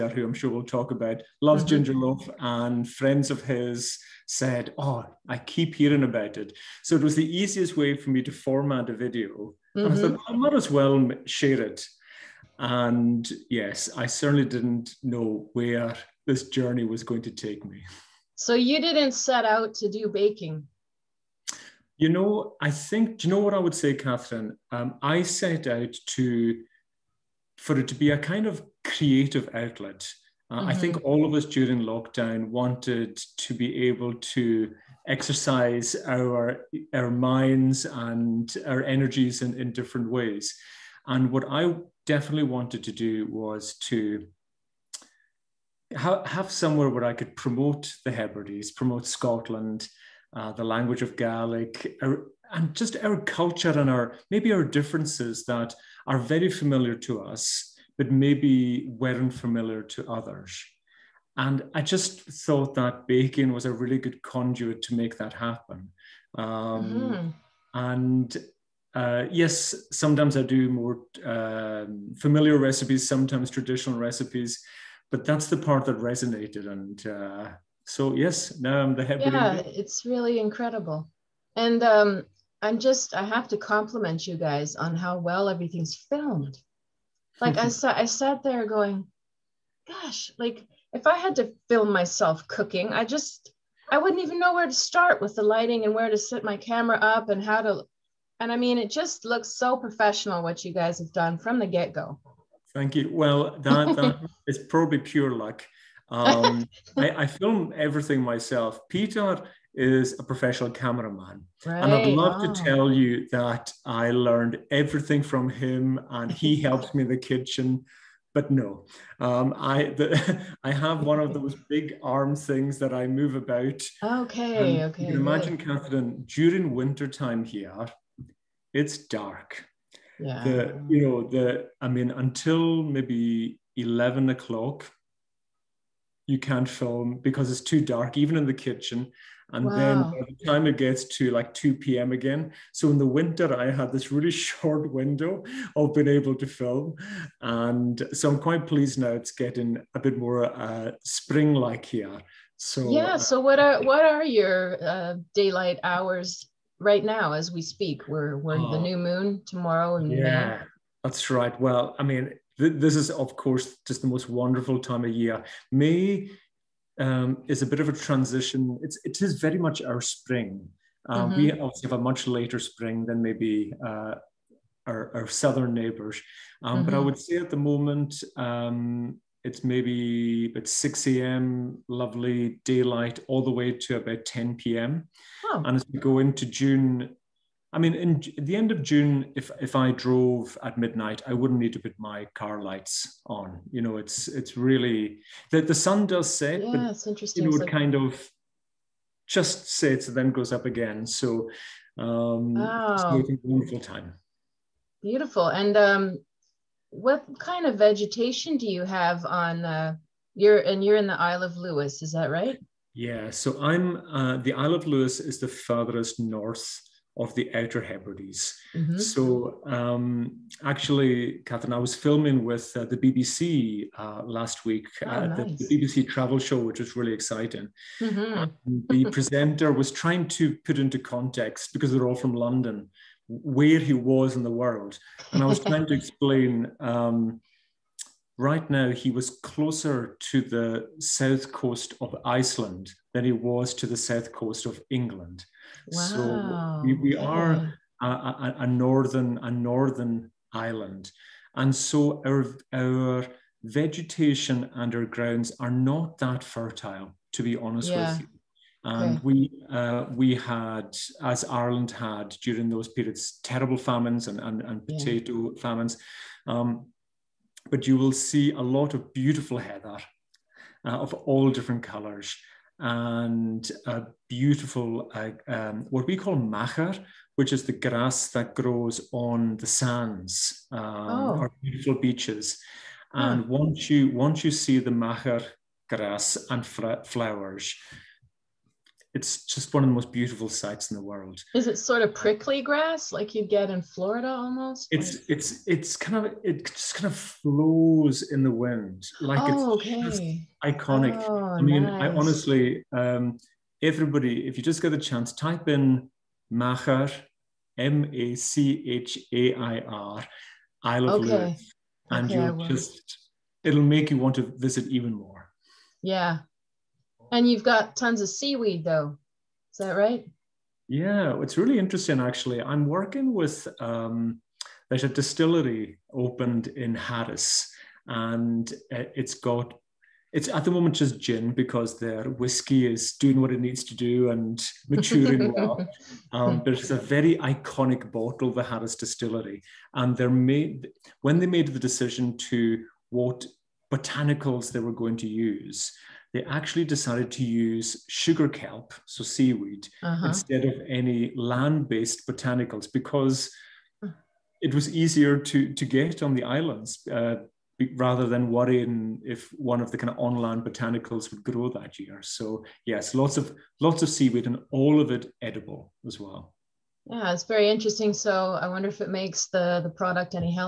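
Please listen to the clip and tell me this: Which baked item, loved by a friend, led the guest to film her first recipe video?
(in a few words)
Ginger loaf.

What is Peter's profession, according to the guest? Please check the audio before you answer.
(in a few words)
Cameraman.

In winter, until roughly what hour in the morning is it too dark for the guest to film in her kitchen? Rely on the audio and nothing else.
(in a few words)
11 o'clock.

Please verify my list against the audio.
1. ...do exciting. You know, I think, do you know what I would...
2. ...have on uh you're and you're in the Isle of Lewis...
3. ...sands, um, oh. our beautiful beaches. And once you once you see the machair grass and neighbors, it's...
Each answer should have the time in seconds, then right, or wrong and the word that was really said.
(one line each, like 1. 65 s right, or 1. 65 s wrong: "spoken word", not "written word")
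1. 19 s wrong: "baking", not "exciting"
2. 208 s right
3. 279 s wrong: "flowers", not "neighbors".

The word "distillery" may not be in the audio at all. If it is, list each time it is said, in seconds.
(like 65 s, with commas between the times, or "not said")
325 s, 338 s.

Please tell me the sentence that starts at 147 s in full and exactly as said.
And so I'm quite pleased now it's getting a bit more uh, spring like here.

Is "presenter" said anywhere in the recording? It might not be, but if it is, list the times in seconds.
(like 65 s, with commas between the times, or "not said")
229 s.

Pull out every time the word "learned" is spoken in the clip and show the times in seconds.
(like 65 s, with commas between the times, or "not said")
114 s.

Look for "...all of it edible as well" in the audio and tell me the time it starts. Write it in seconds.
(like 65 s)
364 s.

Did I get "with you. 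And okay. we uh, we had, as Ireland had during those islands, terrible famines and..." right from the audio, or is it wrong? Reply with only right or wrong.
wrong.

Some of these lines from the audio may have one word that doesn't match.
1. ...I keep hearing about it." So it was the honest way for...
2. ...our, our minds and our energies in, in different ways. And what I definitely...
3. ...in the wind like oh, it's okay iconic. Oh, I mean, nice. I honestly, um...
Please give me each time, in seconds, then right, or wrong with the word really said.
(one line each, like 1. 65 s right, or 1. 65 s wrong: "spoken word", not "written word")
1. 5 s wrong: "easiest", not "honest"
2. 36 s right
3. 298 s right.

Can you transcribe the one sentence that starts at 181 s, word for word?
lovely daylight all the way to about 10 p.m.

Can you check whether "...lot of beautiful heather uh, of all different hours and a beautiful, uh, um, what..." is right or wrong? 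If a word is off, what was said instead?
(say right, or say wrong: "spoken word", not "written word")
wrong: "colors", not "hours".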